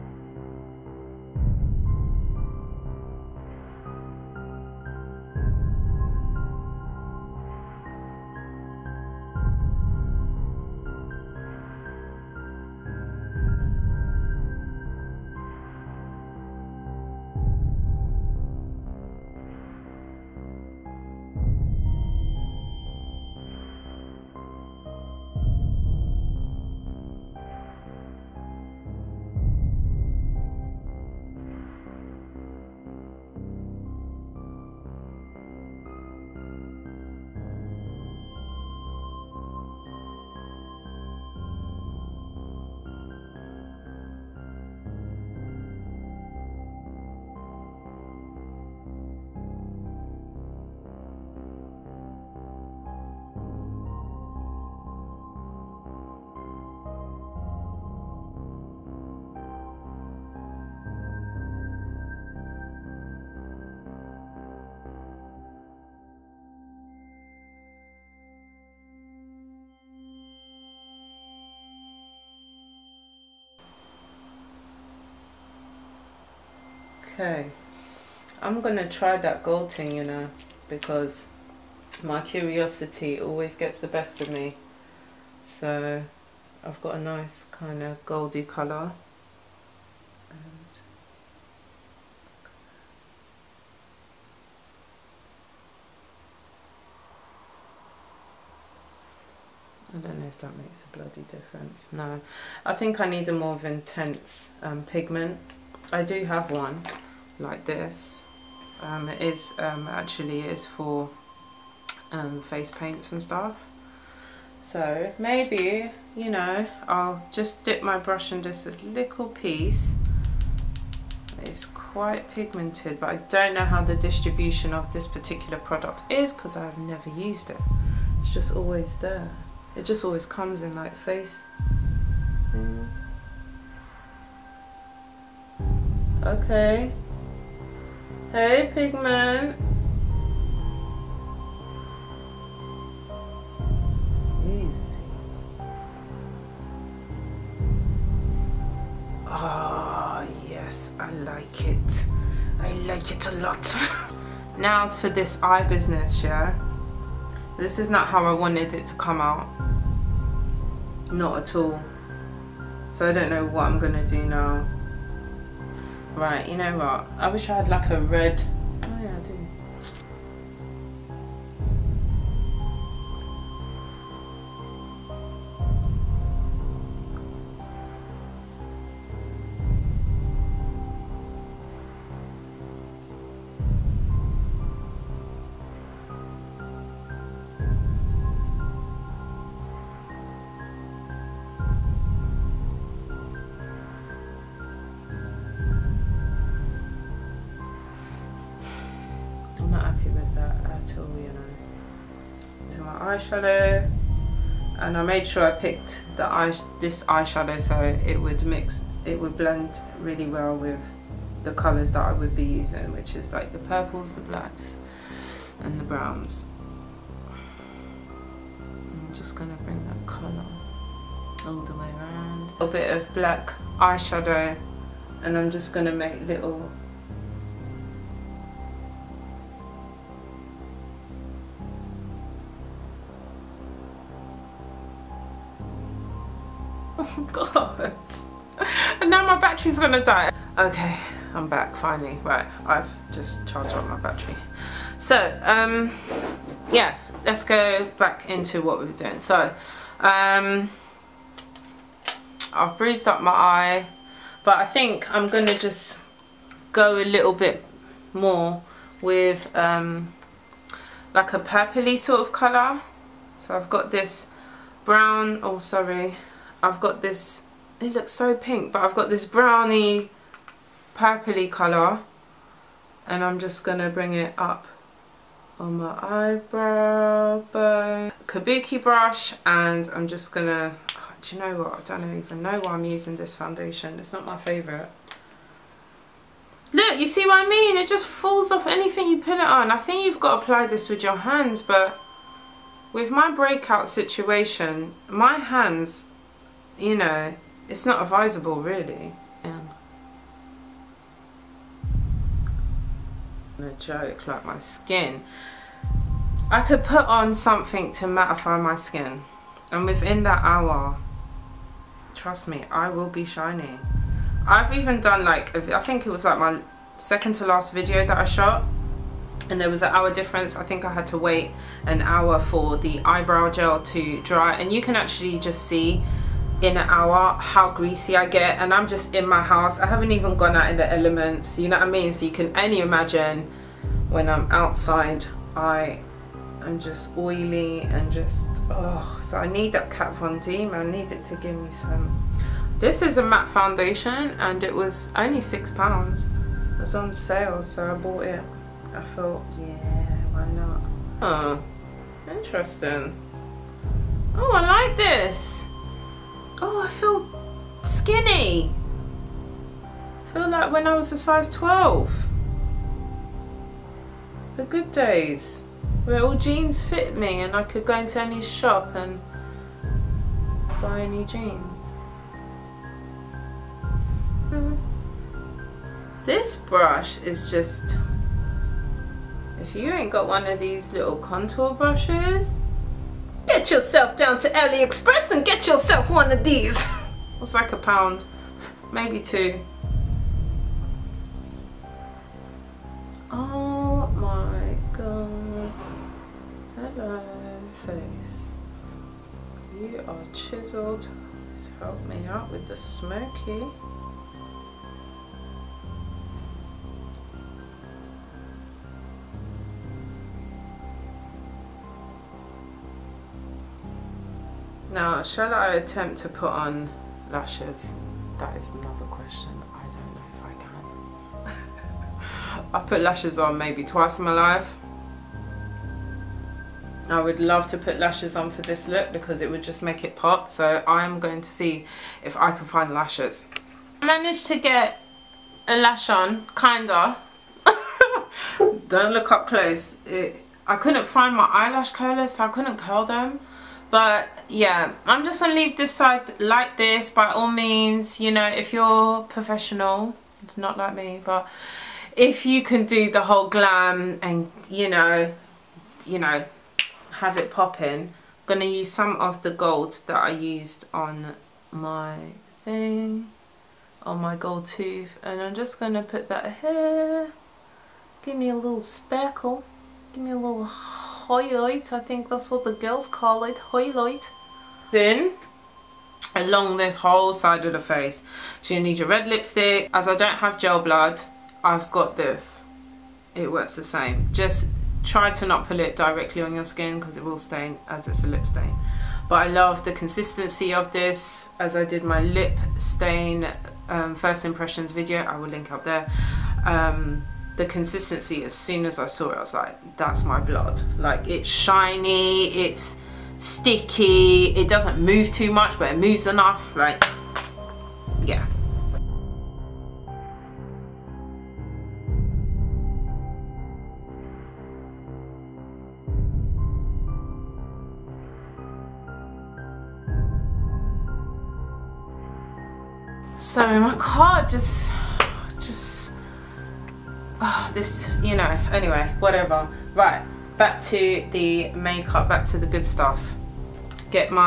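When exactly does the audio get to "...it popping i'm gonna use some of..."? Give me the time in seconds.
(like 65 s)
457 s.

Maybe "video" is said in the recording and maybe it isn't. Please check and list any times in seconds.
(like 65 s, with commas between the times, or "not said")
317 s, 494 s.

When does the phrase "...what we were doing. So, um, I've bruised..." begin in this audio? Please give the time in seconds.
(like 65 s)
248 s.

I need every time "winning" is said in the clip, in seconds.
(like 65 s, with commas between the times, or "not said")
not said.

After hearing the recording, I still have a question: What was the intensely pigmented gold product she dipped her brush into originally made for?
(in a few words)
face paints.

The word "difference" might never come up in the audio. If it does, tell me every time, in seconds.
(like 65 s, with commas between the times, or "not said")
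101 s, 320 s.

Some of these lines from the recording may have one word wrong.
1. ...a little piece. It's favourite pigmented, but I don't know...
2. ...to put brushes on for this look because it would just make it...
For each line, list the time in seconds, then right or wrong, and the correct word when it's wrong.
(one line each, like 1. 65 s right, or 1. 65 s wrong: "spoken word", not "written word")
1. 118 s wrong: "quite", not "favourite"
2. 427 s wrong: "lashes", not "brushes".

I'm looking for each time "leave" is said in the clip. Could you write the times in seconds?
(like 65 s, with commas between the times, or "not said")
445 s.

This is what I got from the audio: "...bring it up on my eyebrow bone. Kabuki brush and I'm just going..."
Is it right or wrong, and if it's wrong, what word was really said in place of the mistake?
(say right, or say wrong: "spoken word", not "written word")
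right.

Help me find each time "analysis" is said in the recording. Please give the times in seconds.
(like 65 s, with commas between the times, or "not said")
not said.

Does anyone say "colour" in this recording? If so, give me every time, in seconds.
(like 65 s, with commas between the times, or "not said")
88 s, 211 s, 220 s, 262 s, 271 s.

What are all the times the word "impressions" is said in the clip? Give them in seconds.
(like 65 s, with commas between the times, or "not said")
494 s.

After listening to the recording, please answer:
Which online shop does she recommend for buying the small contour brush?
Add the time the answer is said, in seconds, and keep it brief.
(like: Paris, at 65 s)
AliExpress, at 384 s.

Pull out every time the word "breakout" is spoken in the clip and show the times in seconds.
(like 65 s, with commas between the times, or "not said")
293 s.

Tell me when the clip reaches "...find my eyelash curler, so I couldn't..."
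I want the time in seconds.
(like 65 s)
441 s.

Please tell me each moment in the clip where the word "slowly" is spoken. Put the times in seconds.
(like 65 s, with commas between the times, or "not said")
not said.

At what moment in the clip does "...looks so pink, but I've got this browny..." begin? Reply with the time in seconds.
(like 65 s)
267 s.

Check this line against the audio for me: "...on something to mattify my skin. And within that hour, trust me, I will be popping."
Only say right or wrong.
wrong.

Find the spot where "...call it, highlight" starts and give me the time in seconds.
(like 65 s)
473 s.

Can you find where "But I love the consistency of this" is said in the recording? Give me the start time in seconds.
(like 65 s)
489 s.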